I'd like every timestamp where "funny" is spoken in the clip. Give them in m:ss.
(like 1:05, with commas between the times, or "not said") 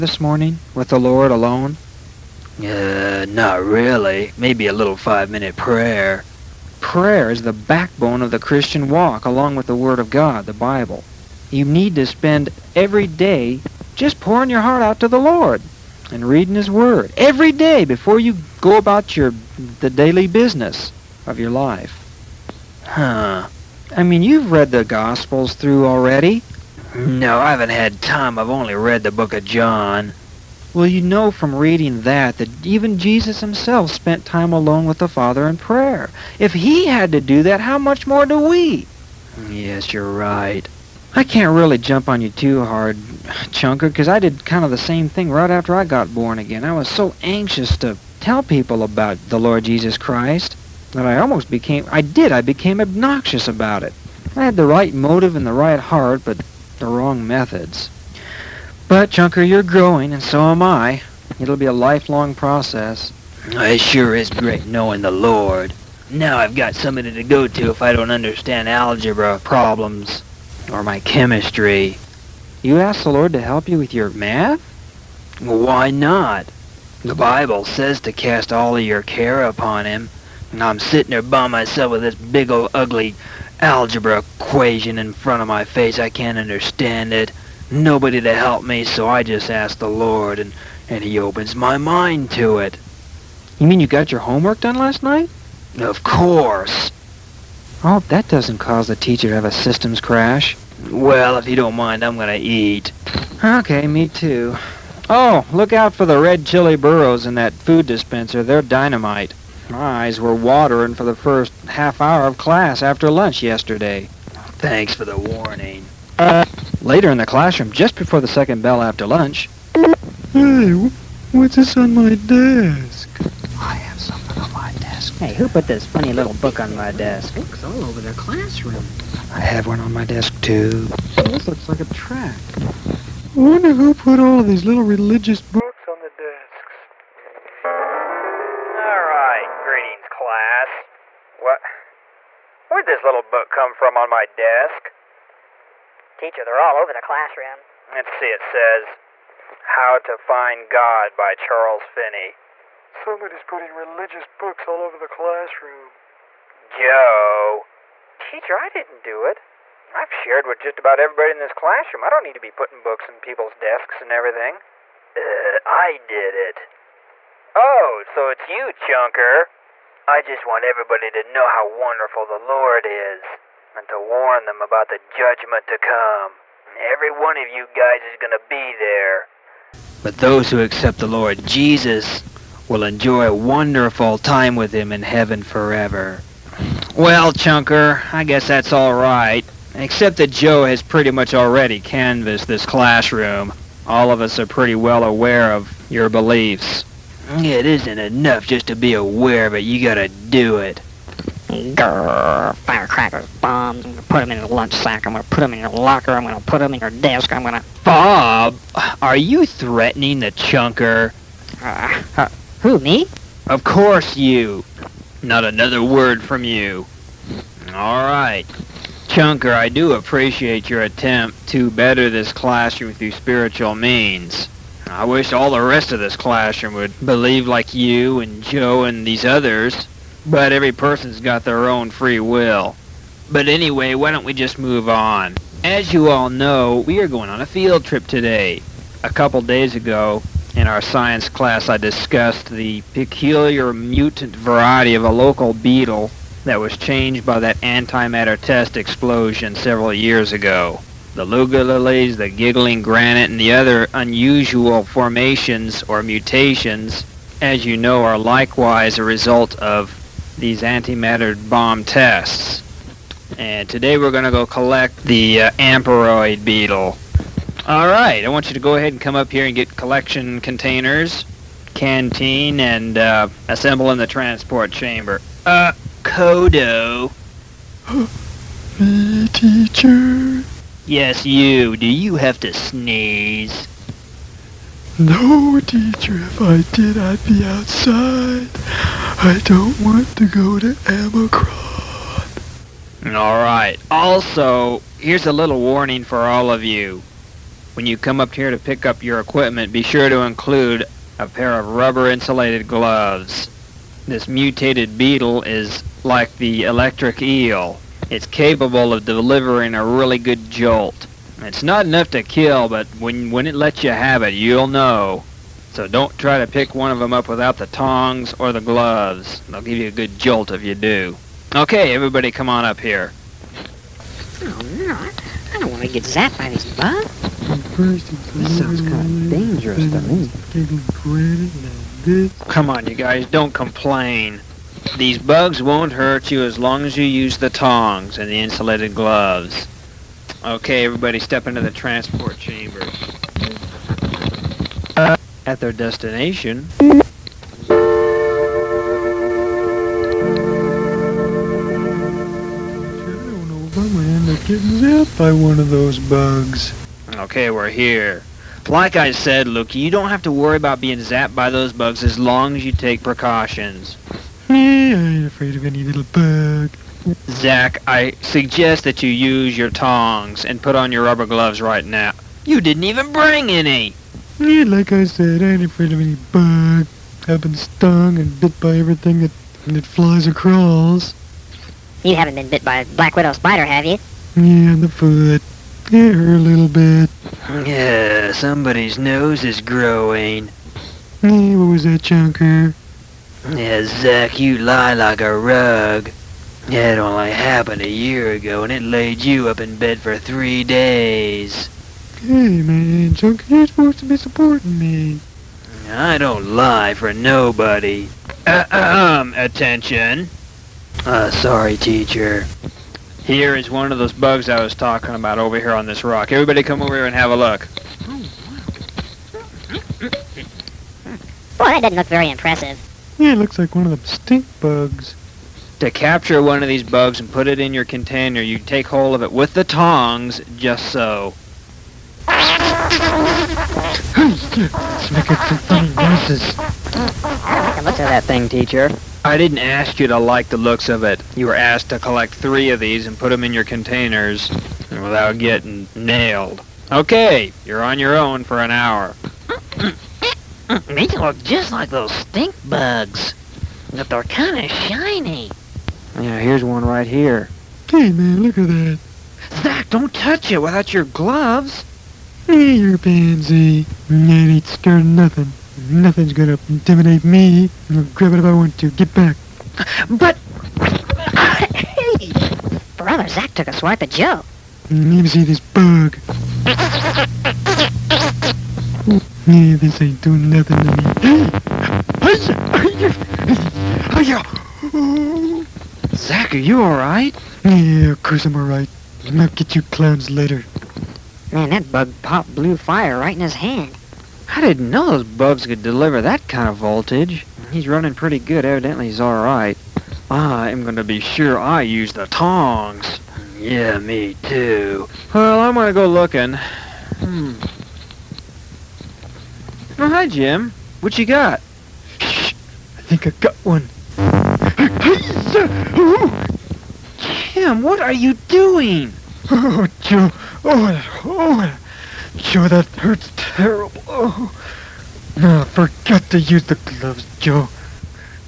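2:05, 7:15.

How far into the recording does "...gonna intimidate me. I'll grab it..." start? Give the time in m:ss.
7:46.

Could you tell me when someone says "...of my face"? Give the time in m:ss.
1:25.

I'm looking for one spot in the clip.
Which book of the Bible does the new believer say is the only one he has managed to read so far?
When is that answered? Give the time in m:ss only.
0:29.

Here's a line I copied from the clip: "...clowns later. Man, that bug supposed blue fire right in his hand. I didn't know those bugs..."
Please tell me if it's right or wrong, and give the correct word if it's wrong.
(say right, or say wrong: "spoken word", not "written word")
wrong: "popped", not "supposed".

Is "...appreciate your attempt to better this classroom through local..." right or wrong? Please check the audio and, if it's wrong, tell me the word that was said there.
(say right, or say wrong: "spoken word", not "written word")
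wrong: "spiritual", not "local".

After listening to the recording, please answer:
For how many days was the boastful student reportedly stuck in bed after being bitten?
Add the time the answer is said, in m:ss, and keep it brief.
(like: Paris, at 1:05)
3, at 6:40.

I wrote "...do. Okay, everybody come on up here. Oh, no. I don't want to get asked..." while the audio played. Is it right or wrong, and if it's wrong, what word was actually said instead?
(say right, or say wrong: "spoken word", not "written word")
wrong: "zapped", not "asked".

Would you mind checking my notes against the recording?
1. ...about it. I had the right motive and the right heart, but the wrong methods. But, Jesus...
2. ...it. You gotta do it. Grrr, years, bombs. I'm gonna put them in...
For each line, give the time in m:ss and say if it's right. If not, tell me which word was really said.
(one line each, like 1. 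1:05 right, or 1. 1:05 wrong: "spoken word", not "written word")
1. 0:53 wrong: "Chunker", not "Jesus"
2. 3:19 wrong: "firecrackers", not "years".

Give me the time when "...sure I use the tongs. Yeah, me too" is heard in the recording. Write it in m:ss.
8:21.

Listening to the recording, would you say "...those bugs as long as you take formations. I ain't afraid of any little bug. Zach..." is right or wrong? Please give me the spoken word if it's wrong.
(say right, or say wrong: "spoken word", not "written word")
wrong: "precautions", not "formations".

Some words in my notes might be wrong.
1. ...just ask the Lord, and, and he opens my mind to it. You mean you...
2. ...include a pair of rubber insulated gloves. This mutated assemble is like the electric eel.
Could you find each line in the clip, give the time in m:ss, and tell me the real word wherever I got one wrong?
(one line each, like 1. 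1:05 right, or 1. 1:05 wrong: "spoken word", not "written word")
1. 1:29 right
2. 5:00 wrong: "beetle", not "assemble".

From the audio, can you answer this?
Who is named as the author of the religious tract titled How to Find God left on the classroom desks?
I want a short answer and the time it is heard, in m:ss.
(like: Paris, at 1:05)
Charles Finney, at 2:31.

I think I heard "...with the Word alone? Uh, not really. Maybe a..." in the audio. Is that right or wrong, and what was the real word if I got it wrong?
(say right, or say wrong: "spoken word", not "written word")
wrong: "Lord", not "Word".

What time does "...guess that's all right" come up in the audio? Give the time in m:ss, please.
3:08.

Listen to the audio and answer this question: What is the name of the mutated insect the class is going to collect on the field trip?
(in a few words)
Amperoid beetle.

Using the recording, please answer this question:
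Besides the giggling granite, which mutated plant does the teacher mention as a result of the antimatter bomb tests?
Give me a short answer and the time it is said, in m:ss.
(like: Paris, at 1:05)
Luga lilies, at 4:11.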